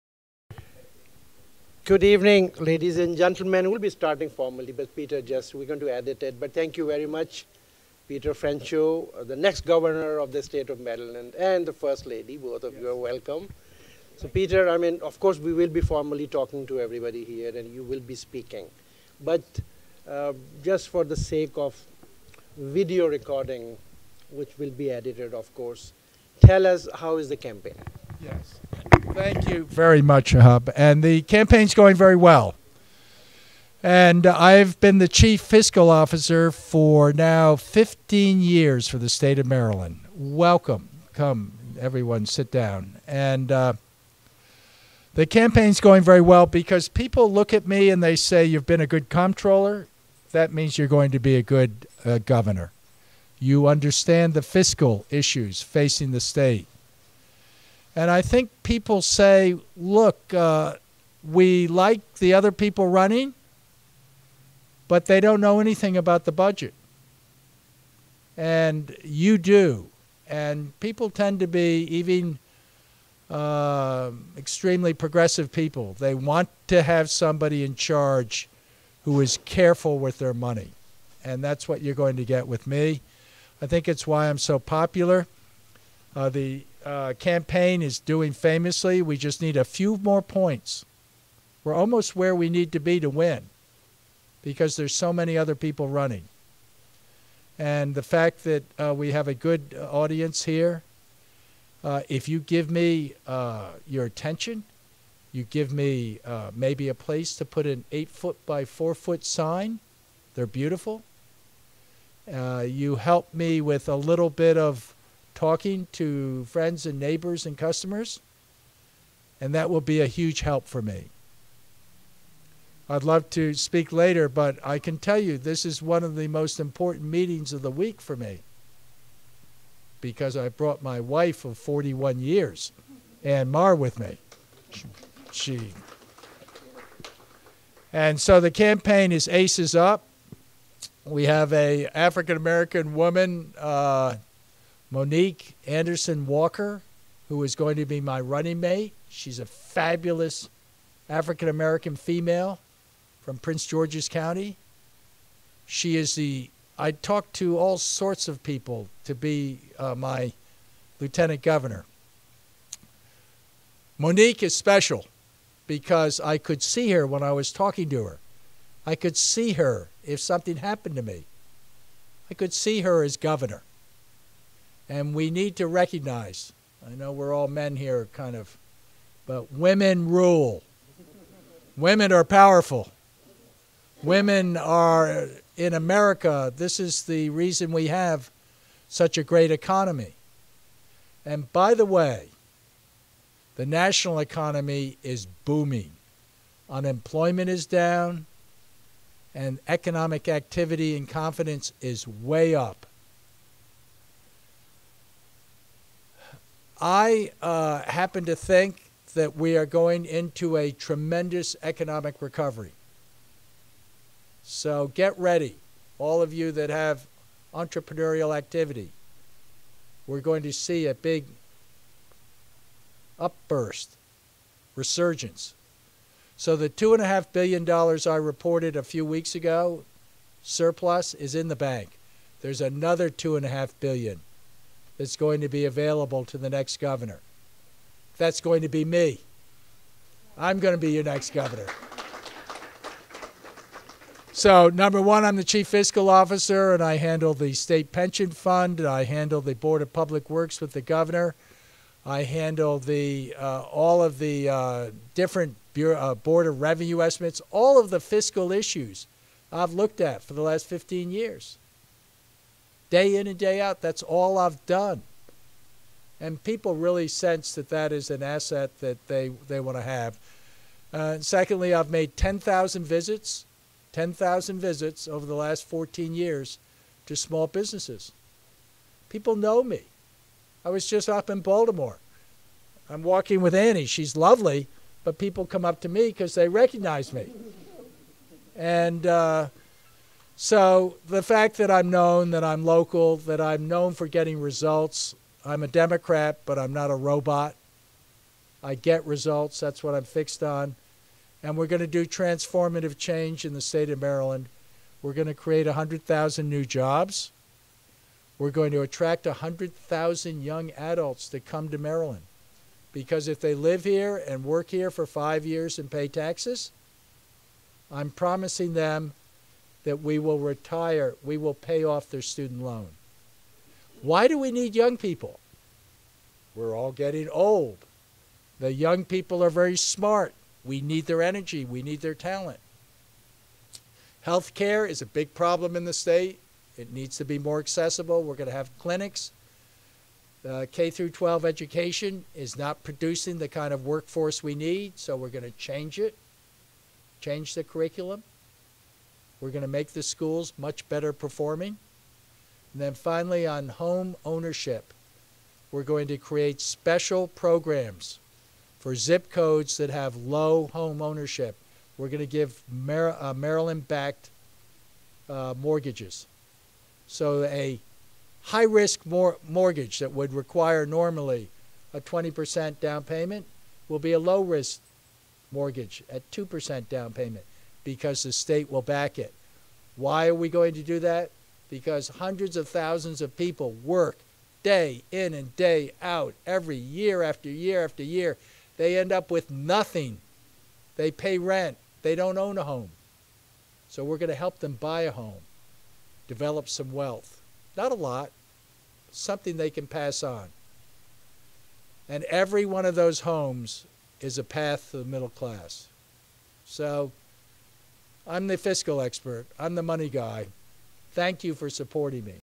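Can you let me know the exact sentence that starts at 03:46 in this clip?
So the $2.5 billion I reported a few weeks ago, surplus, is in the bank.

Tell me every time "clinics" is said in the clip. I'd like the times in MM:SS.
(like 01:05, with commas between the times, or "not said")
05:38.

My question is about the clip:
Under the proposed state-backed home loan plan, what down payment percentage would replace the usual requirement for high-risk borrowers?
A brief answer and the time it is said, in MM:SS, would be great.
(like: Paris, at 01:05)
2%, at 06:16.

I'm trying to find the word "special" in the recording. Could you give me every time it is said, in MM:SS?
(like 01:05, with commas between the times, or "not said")
02:44, 05:56.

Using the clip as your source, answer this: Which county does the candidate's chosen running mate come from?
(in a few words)
Prince George's County.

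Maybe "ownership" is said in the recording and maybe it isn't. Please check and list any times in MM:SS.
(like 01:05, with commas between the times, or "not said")
05:54, 06:01.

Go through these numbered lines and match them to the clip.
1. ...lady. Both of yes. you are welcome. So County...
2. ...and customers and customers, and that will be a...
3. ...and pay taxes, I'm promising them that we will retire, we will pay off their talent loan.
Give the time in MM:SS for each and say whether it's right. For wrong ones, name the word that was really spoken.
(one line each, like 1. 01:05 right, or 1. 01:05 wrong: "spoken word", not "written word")
1. 00:12 wrong: "Peter", not "County"
2. 01:56 wrong: "neighbors", not "customers"
3. 05:15 wrong: "student", not "talent".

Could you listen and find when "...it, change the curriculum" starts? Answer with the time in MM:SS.
05:45.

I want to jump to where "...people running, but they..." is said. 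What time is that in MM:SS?
01:02.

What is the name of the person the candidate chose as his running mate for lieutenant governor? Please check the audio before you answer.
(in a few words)
Monique Anderson Walker.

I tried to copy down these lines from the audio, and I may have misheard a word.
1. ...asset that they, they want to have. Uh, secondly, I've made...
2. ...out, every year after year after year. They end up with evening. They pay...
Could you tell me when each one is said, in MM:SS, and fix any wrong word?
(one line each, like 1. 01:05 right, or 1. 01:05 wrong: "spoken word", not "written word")
1. 04:28 right
2. 06:26 wrong: "nothing", not "evening".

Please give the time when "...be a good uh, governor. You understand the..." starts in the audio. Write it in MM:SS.
00:51.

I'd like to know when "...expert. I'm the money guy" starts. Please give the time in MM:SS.
06:49.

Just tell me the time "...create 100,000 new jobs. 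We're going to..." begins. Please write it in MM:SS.
05:05.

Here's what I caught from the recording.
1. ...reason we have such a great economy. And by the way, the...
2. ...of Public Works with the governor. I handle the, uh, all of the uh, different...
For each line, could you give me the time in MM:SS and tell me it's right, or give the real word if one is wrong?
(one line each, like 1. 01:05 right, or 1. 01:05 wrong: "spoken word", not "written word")
1. 03:07 right
2. 04:09 right.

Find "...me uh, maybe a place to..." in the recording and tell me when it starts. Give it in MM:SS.
01:45.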